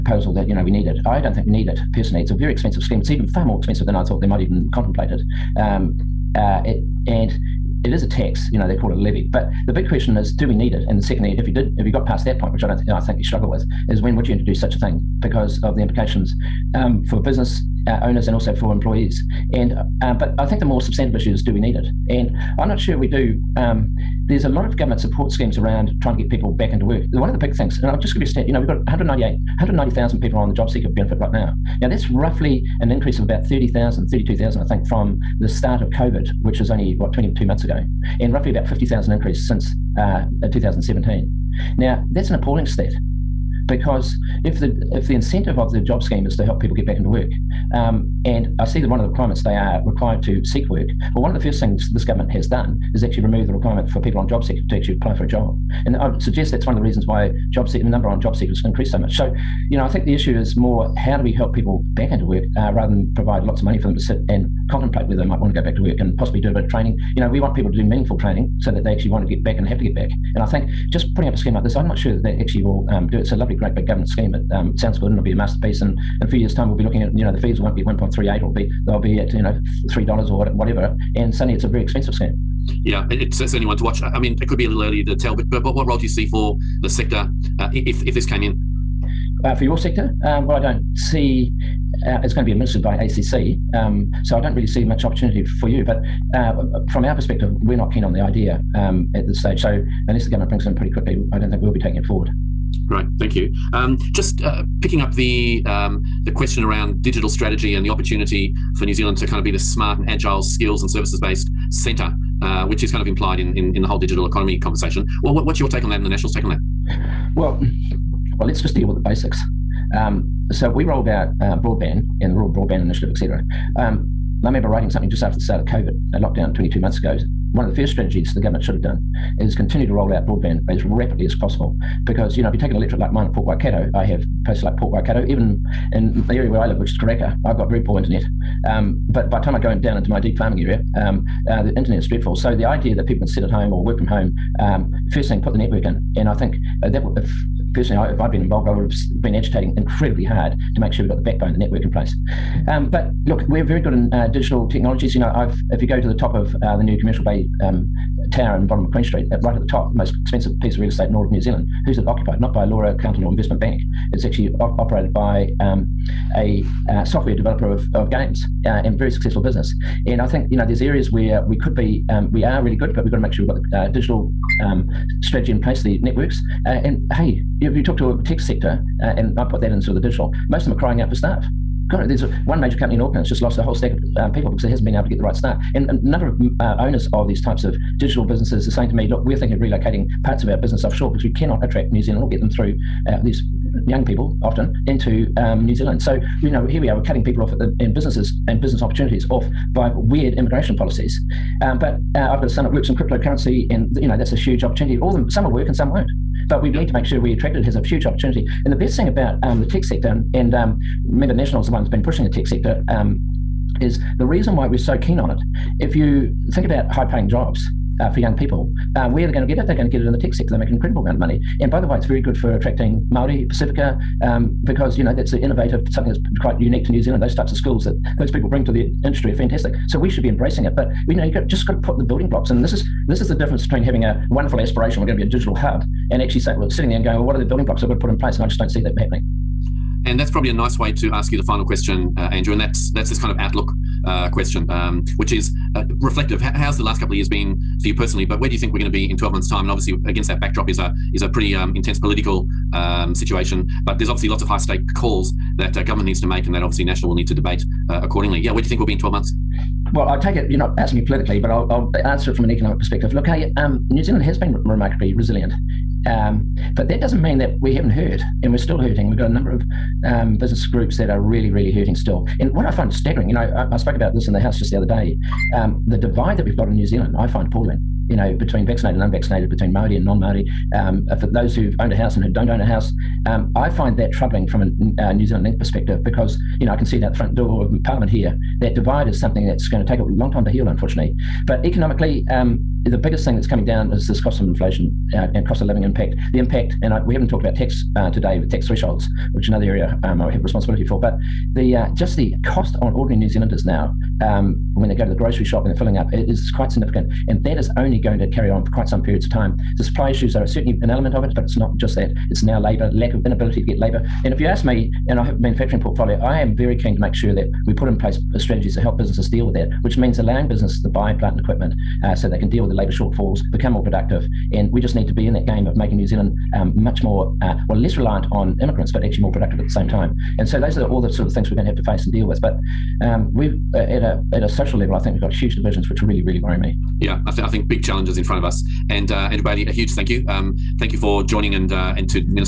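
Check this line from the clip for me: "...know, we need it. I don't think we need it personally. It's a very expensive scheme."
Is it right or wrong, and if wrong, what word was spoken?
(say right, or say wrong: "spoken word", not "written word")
right.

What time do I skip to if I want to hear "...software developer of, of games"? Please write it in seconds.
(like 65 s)
167 s.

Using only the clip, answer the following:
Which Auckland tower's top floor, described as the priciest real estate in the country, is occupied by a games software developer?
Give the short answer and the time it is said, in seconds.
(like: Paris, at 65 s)
Commercial Bay, at 156 s.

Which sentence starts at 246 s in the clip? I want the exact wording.
how's the last couple of years been for you personally?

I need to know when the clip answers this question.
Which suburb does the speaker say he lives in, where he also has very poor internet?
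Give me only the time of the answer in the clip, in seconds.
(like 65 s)
136 s.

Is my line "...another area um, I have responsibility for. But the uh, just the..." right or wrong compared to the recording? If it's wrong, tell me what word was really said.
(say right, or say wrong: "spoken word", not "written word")
right.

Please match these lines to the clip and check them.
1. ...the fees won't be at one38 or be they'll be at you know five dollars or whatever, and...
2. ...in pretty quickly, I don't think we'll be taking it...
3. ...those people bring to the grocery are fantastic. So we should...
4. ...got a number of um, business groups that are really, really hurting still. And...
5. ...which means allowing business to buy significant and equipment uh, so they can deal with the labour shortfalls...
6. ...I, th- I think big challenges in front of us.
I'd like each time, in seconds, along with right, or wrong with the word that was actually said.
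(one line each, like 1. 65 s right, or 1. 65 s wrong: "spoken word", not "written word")
1. 77 s wrong: "three", not "five"
2. 100 s right
3. 228 s wrong: "industry", not "grocery"
4. 269 s right
5. 319 s wrong: "plant", not "significant"
6. 337 s right.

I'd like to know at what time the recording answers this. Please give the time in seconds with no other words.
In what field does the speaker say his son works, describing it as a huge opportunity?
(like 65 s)
202 s.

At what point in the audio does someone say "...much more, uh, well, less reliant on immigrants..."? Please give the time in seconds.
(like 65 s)
326 s.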